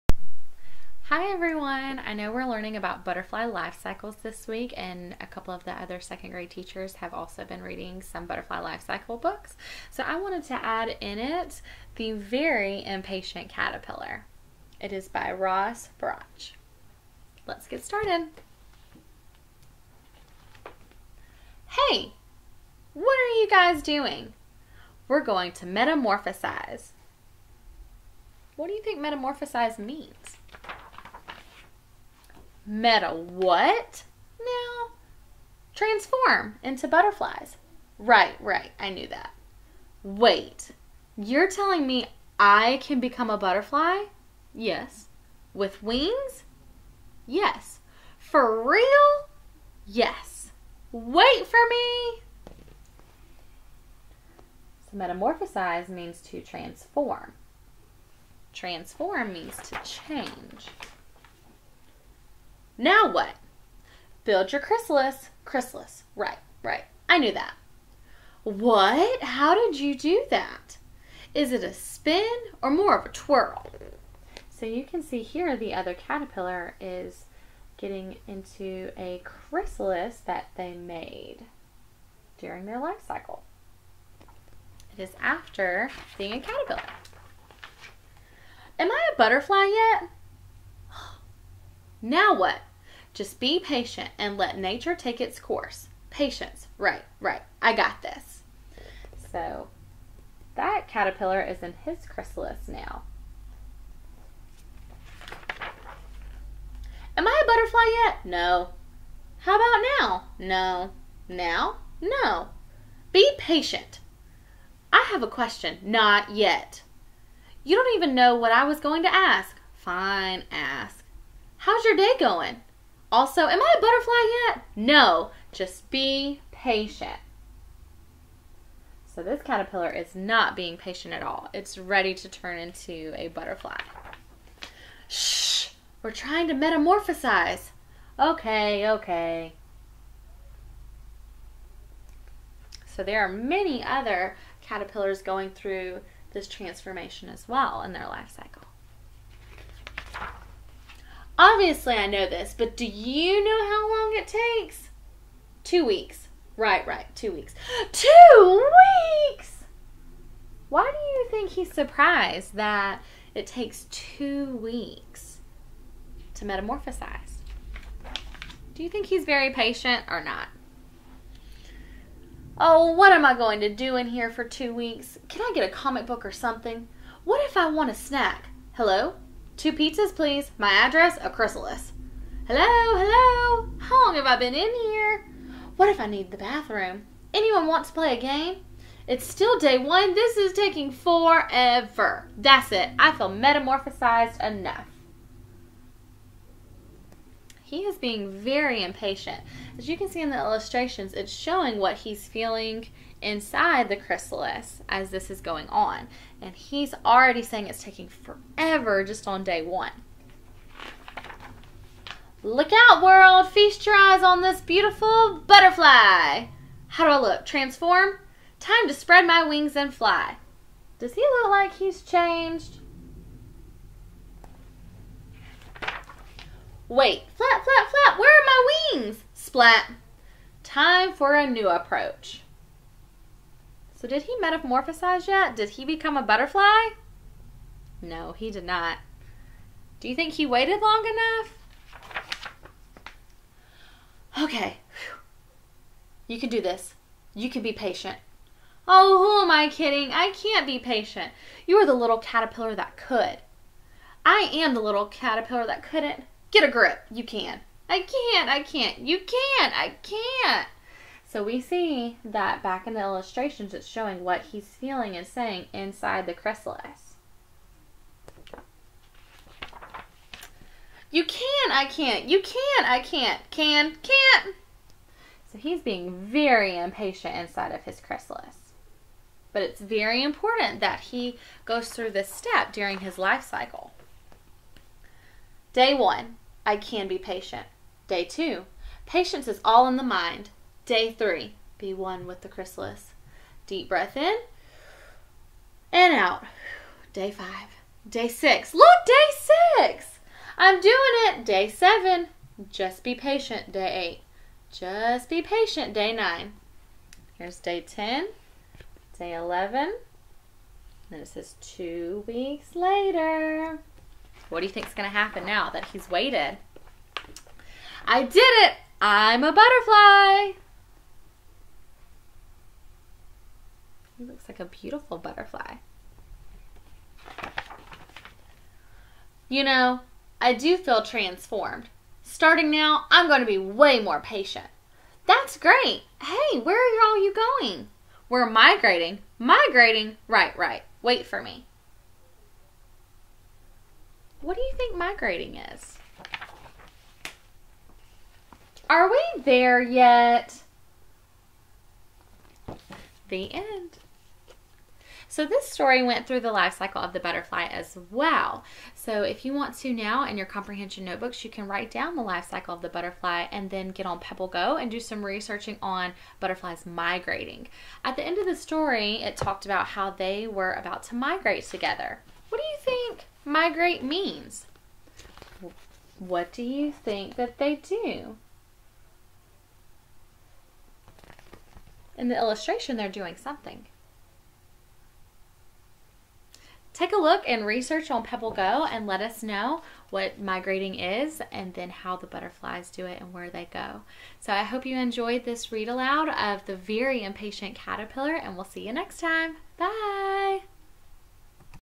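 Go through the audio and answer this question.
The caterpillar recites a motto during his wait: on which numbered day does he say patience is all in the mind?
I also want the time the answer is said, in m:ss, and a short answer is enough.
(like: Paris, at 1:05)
Day two, at 4:48.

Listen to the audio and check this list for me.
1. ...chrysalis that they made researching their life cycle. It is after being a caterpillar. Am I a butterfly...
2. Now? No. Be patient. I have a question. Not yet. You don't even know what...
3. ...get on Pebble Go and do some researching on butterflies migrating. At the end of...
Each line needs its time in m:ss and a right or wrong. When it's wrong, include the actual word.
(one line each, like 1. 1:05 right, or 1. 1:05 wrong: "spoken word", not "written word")
1. 1:19 wrong: "during", not "researching"
2. 1:51 right
3. 6:03 right.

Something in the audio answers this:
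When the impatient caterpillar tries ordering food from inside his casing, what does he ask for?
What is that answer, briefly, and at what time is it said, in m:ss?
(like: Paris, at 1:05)
Two pizzas, at 2:59.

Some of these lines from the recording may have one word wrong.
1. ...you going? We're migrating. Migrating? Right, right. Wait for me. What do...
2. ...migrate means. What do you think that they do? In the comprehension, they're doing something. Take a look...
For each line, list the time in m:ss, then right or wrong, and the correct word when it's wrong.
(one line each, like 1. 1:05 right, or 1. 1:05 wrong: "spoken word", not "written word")
1. 5:37 right
2. 6:13 wrong: "illustration", not "comprehension".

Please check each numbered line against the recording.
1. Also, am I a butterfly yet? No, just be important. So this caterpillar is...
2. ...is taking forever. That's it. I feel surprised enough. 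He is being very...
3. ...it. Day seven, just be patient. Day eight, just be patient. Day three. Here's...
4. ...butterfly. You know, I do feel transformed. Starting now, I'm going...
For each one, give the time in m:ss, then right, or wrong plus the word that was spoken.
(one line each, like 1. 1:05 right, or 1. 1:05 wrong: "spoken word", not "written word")
1. 2:03 wrong: "patient", not "important"
2. 3:10 wrong: "metamorphosized", not "surprised"
3. 5:01 wrong: "nine", not "three"
4. 5:25 right.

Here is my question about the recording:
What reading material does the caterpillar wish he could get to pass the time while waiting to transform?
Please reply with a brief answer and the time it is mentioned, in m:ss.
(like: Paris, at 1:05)
A comic book, at 2:55.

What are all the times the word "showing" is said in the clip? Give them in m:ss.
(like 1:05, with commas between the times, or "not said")
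3:21, 4:23.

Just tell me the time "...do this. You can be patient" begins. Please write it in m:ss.
4:06.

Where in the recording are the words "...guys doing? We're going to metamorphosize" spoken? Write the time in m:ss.
0:23.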